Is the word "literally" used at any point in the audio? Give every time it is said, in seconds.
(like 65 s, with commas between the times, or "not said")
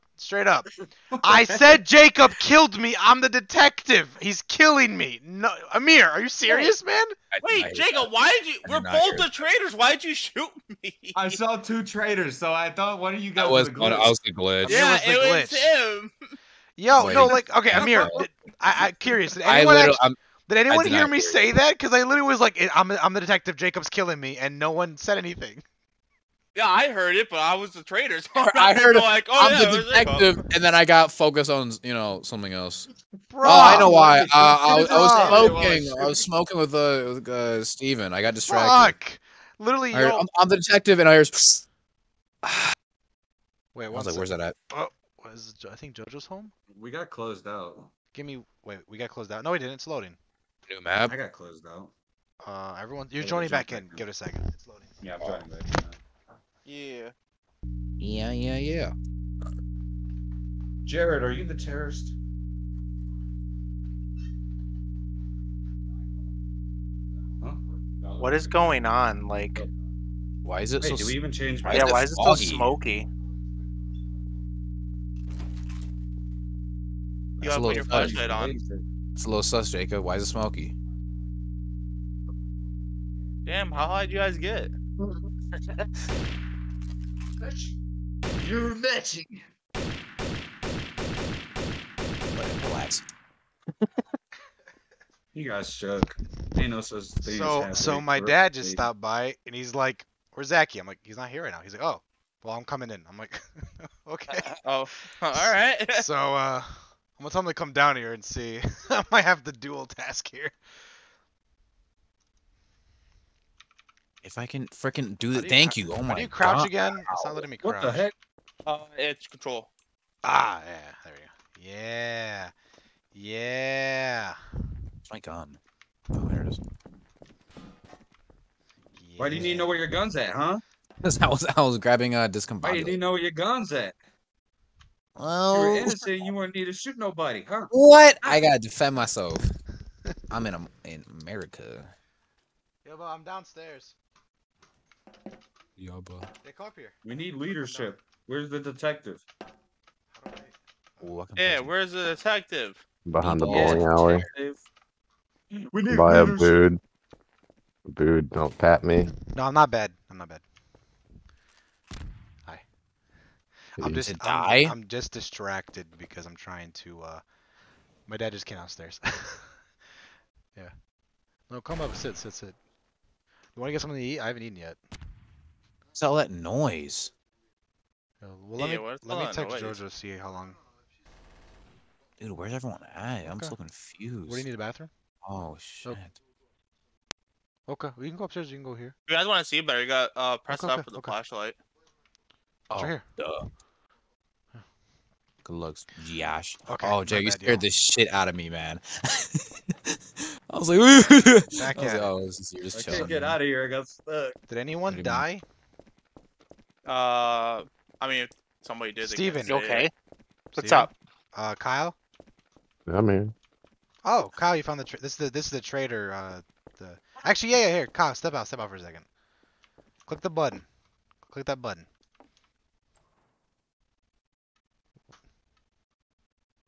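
22 s, 39 s.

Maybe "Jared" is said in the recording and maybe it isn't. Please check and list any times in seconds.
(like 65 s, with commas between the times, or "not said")
60 s.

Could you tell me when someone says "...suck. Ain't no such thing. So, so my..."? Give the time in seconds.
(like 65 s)
95 s.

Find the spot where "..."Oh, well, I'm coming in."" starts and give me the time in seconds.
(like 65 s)
101 s.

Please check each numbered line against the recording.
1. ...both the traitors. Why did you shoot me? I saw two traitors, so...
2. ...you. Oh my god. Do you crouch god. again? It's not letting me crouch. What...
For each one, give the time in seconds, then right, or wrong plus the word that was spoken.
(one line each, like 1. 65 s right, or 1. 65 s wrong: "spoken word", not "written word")
1. 8 s right
2. 115 s right.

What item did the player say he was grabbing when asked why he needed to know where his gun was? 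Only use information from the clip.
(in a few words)
discombobulator.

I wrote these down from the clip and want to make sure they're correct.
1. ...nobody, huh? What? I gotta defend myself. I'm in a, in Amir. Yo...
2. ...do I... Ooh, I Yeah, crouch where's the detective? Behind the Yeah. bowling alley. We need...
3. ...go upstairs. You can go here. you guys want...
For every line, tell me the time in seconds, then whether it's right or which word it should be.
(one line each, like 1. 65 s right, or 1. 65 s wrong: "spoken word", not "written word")
1. 136 s wrong: "America", not "Amir"
2. 150 s wrong: "punch", not "crouch"
3. 188 s right.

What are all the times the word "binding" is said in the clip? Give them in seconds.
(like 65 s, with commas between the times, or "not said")
not said.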